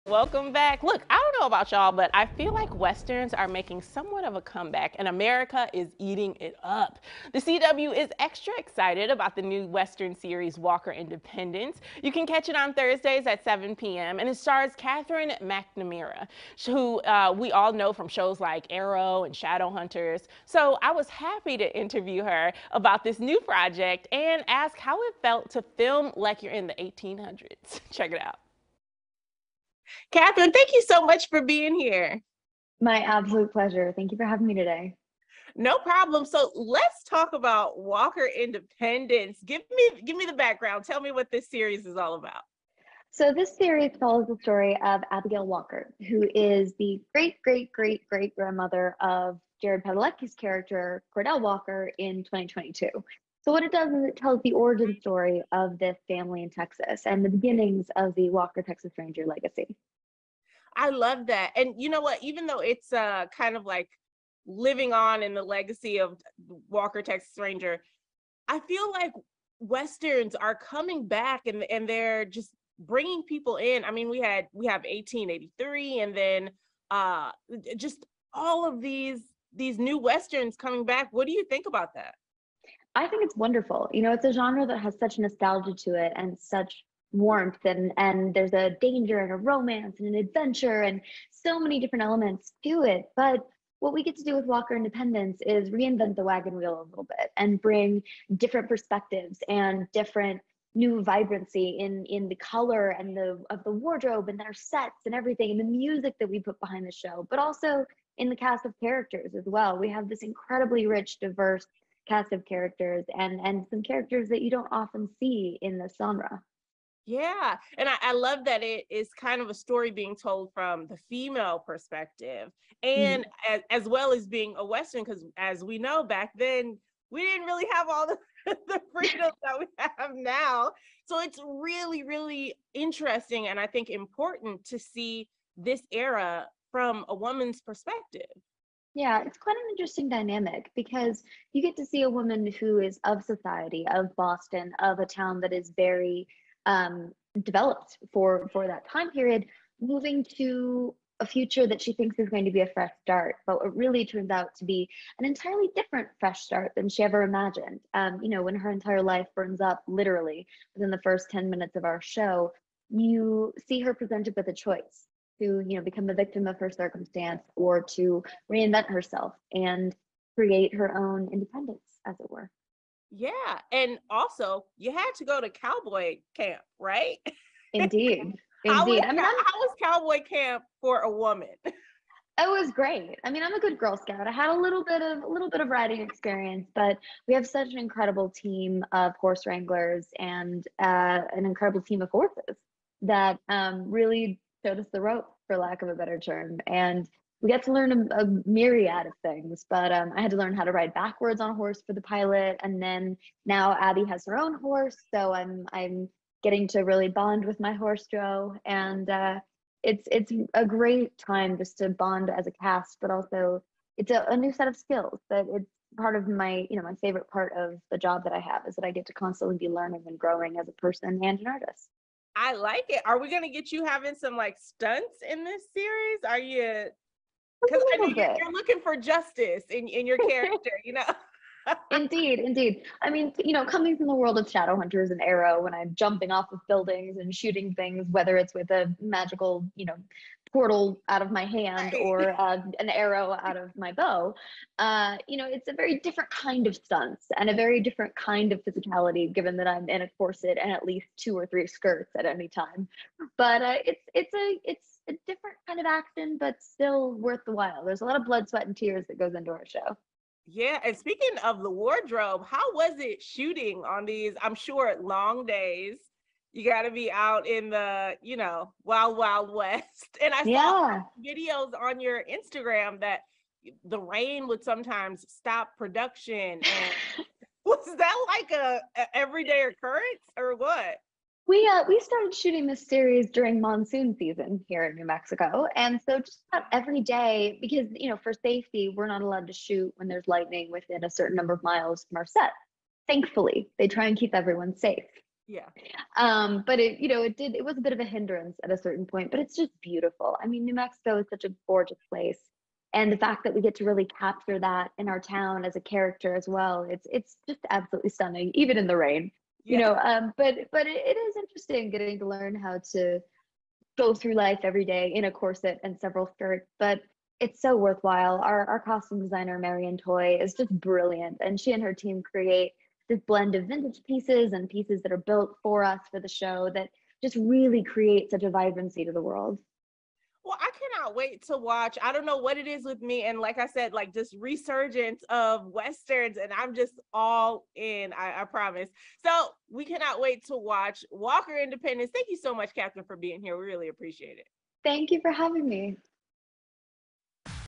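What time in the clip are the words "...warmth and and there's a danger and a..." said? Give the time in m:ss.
1:27.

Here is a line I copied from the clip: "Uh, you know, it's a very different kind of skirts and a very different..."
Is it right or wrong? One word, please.
wrong.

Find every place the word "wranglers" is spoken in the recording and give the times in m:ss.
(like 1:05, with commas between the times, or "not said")
3:09.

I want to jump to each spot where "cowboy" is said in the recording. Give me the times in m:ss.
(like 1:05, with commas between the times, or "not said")
2:55, 2:59.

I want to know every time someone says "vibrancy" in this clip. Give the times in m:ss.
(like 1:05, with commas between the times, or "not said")
1:41, 5:28.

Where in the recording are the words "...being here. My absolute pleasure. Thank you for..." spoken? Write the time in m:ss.
0:31.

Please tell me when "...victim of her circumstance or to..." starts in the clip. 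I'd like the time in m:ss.
2:46.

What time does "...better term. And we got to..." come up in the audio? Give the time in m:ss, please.
3:15.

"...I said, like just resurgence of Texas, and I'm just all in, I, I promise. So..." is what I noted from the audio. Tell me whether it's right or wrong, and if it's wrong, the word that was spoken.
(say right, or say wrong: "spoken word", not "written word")
wrong: "Westerns", not "Texas".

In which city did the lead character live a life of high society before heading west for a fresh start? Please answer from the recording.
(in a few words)
Boston.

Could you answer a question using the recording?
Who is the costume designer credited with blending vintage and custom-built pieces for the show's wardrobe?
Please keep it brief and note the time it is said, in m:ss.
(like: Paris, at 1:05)
Marian Toy, at 5:19.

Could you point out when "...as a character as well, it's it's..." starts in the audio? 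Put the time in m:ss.
5:05.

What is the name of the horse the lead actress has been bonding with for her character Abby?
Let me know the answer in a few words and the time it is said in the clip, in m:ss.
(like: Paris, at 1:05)
Joe, at 3:28.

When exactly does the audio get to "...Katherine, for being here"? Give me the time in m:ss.
5:42.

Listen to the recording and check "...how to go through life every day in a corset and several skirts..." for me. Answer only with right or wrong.
right.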